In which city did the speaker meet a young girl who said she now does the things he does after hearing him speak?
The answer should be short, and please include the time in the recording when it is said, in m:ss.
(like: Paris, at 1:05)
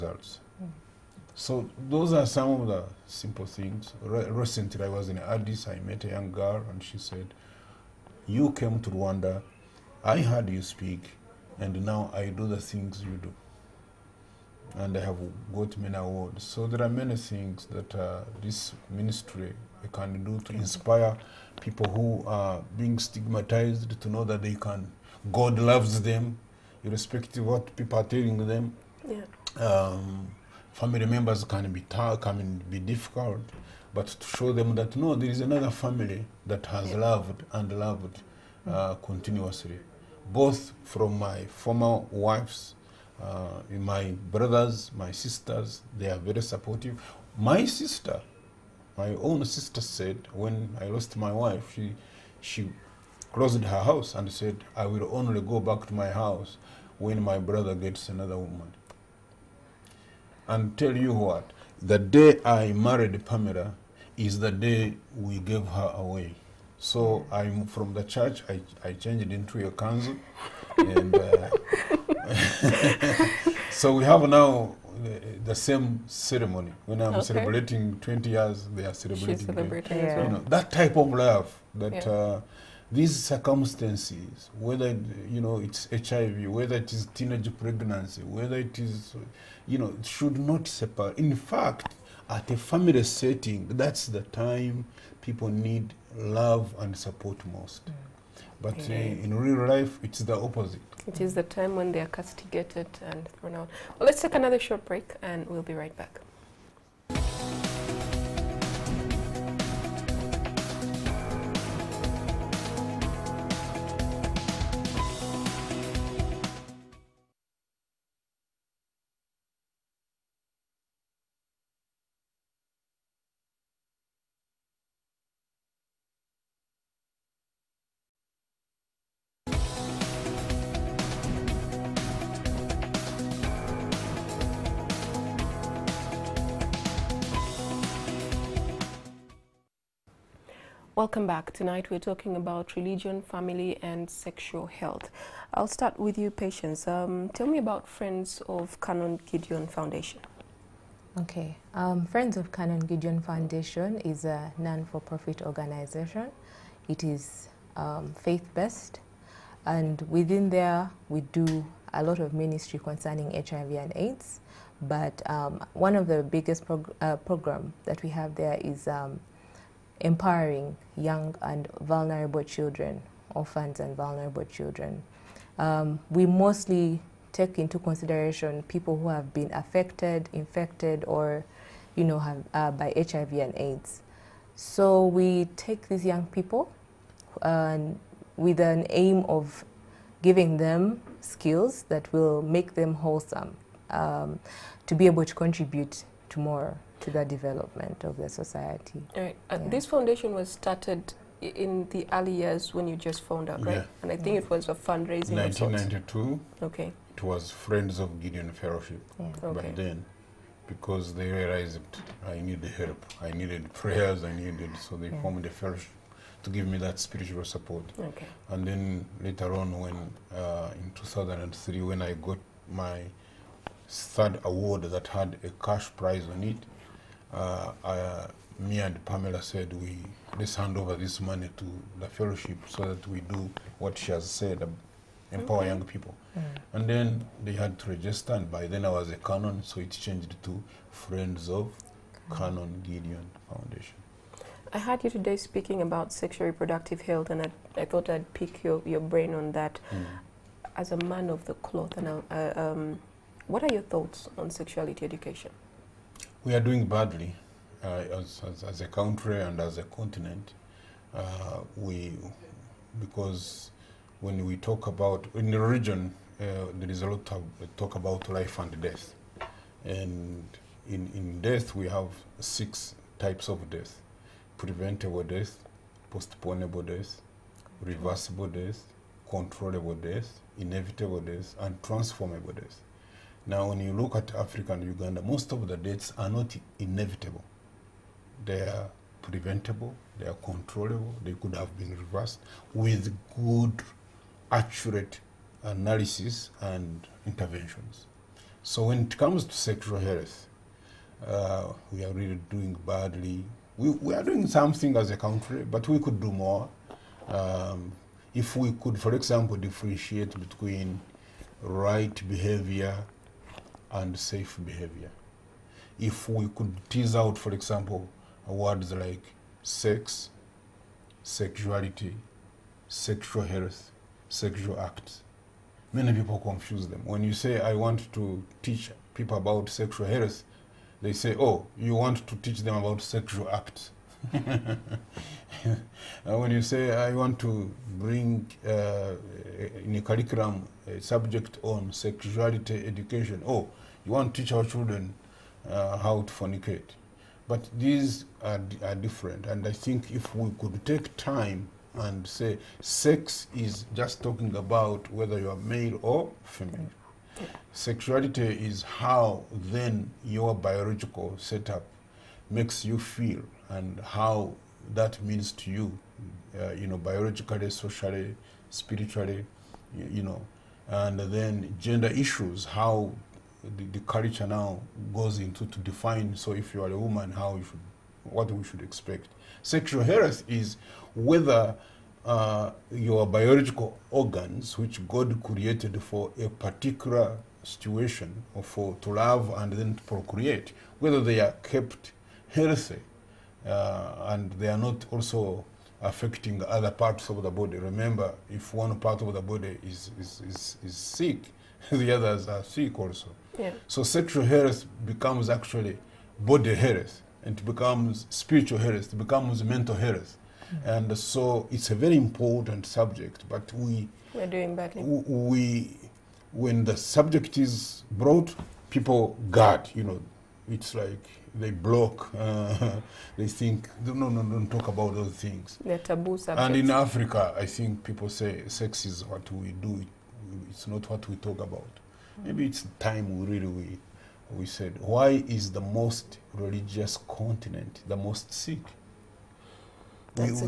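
Addis, at 0:05.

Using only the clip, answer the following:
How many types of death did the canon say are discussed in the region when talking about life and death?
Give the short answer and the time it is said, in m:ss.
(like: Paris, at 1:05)
6, at 4:32.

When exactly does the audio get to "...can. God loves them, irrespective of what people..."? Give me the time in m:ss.
0:24.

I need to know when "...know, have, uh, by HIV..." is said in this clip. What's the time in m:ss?
3:02.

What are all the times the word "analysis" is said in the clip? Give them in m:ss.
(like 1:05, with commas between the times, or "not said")
4:55.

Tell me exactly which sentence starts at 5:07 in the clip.
Um, if we could, for example, differentiate between right behavior and safe behavior.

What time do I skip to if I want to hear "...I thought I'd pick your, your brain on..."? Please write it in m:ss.
4:07.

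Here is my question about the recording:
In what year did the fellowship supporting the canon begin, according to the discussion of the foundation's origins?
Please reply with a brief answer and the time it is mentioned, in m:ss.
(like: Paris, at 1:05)
1992, at 3:25.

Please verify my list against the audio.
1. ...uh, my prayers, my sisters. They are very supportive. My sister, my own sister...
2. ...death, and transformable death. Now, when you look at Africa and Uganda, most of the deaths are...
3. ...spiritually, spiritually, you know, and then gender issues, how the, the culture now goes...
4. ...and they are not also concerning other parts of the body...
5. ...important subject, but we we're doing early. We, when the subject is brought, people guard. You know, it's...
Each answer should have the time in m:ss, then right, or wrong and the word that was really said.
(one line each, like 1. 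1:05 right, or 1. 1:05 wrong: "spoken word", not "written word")
1. 0:43 wrong: "brothers", not "prayers"
2. 4:41 right
3. 6:07 wrong: "socially", not "spiritually"
4. 6:34 wrong: "affecting", not "concerning"
5. 6:52 wrong: "badly", not "early".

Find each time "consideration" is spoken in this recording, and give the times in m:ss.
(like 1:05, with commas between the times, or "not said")
2:57.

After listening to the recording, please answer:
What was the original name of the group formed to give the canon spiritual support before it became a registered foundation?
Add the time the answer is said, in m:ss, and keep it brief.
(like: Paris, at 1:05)
Friends of Gideon Fellowship, at 3:27.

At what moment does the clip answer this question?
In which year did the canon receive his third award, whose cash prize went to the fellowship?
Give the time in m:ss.
3:40.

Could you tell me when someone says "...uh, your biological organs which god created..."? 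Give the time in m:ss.
6:22.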